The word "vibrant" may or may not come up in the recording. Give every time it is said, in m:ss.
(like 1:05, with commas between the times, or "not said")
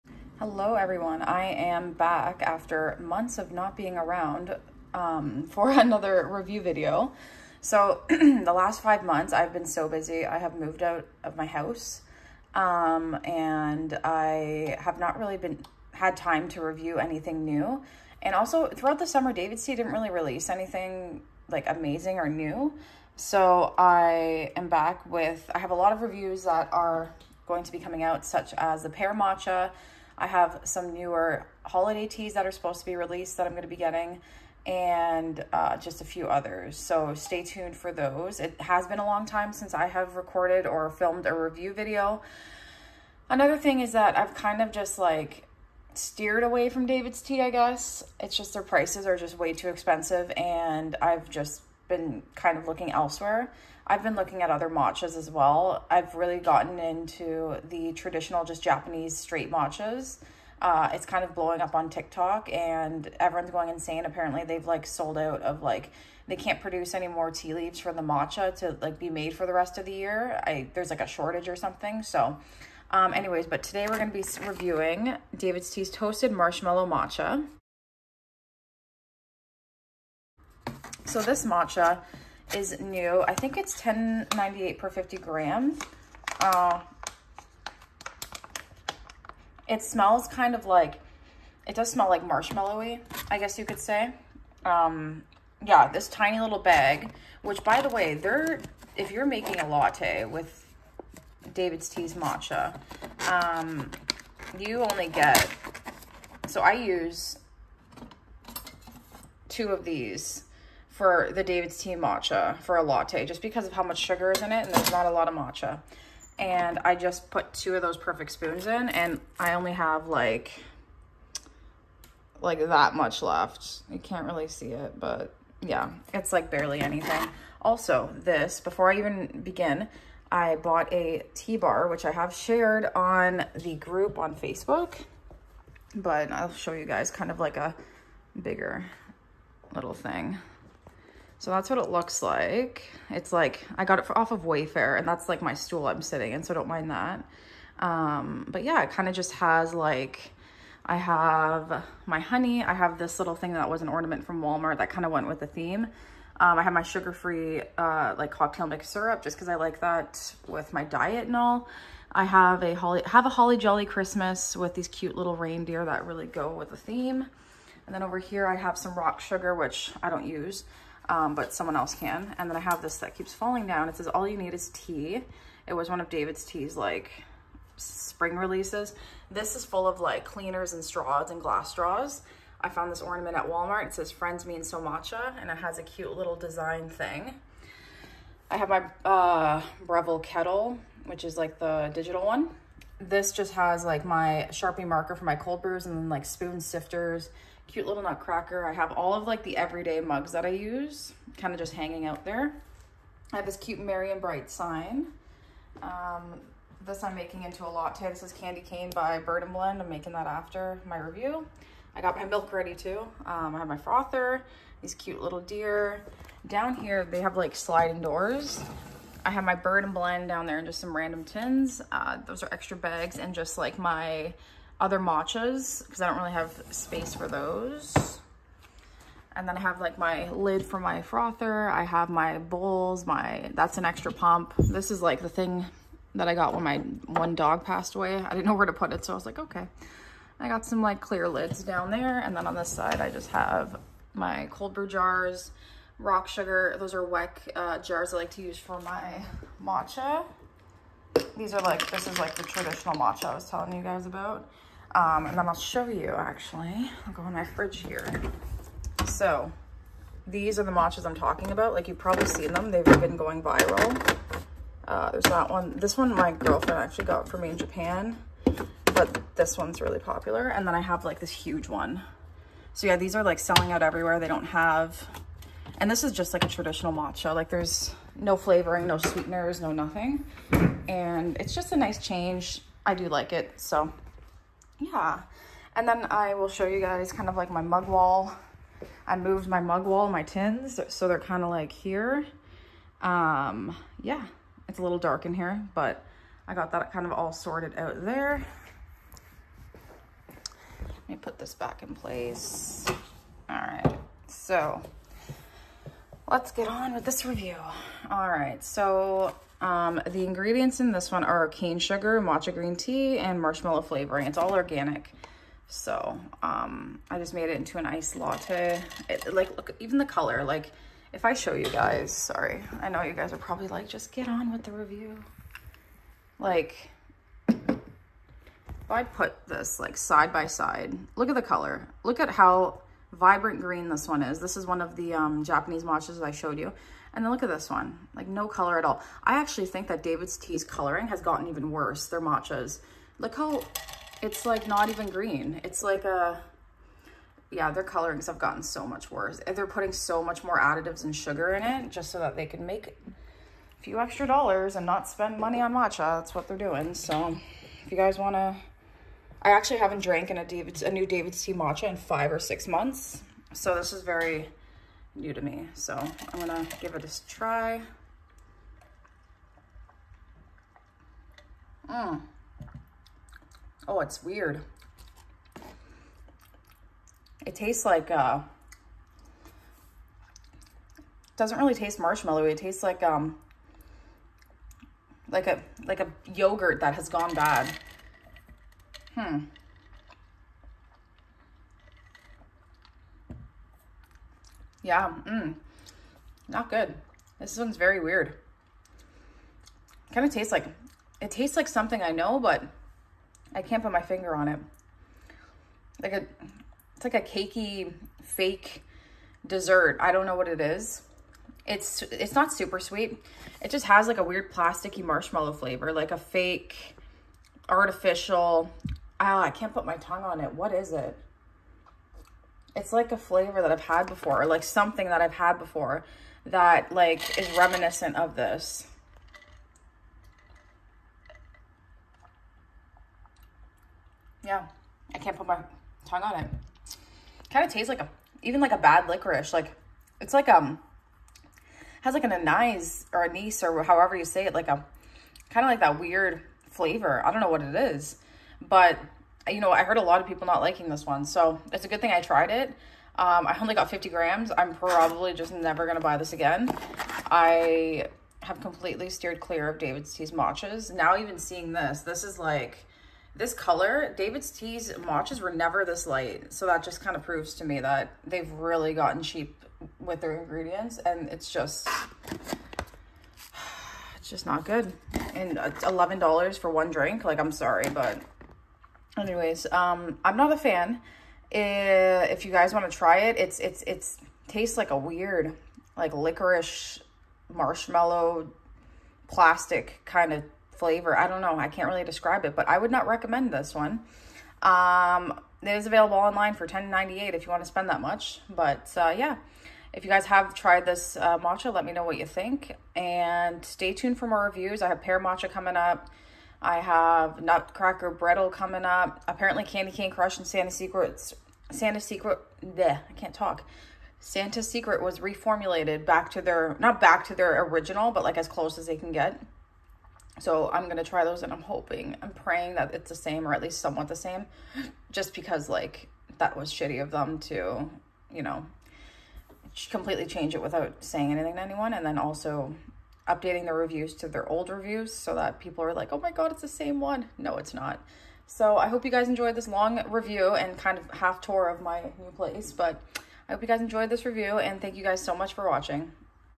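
5:33.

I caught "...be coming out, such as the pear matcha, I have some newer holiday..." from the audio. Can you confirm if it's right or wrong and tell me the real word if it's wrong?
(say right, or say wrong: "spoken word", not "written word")
right.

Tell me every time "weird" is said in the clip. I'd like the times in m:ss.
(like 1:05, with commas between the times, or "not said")
6:14, 6:37, 6:54, 7:25, 8:04.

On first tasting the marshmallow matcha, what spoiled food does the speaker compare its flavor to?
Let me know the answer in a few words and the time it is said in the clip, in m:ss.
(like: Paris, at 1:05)
yogurt, at 6:26.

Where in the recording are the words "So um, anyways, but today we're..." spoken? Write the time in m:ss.
1:12.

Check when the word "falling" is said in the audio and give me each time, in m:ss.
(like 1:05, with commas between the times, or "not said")
2:53.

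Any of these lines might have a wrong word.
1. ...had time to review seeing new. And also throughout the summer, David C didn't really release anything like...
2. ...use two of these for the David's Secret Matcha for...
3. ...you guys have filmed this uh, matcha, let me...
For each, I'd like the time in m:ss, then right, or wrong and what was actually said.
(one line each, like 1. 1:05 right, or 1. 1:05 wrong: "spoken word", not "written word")
1. 0:15 wrong: "anything", not "seeing"
2. 1:46 wrong: "Tea", not "Secret"
3. 8:20 wrong: "tried", not "filmed".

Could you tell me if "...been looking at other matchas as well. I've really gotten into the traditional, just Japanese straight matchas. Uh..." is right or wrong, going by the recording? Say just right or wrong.
right.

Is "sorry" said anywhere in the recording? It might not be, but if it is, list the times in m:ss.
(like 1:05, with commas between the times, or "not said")
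5:22, 7:57.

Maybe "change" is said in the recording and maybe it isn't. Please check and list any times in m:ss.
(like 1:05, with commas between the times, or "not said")
4:42, 8:50.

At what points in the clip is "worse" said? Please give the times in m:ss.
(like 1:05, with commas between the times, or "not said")
5:41, 5:49.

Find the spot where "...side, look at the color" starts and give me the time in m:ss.
5:30.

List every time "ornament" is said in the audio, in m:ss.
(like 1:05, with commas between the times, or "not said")
2:33, 3:03.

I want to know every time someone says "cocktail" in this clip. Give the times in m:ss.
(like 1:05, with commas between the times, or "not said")
2:38.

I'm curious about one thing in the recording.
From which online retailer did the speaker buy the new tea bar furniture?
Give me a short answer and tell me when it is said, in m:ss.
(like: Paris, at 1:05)
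Wayfair, at 2:24.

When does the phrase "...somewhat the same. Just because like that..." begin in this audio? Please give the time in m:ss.
8:43.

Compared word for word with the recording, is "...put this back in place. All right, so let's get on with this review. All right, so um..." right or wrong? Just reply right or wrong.
right.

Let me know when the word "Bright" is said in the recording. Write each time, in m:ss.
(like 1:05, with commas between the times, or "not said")
3:24.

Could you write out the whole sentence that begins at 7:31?
So it's a good thing I tried it.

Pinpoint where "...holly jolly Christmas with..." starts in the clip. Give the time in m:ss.
2:43.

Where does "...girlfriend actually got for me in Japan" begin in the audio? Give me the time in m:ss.
4:26.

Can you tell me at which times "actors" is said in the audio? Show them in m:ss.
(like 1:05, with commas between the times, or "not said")
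not said.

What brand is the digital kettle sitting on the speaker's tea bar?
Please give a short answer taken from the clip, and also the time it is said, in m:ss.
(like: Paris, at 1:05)
Breville, at 3:09.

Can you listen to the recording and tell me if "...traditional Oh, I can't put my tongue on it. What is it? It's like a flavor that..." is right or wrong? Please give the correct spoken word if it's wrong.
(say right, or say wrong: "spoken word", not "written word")
wrong: "artificial", not "traditional".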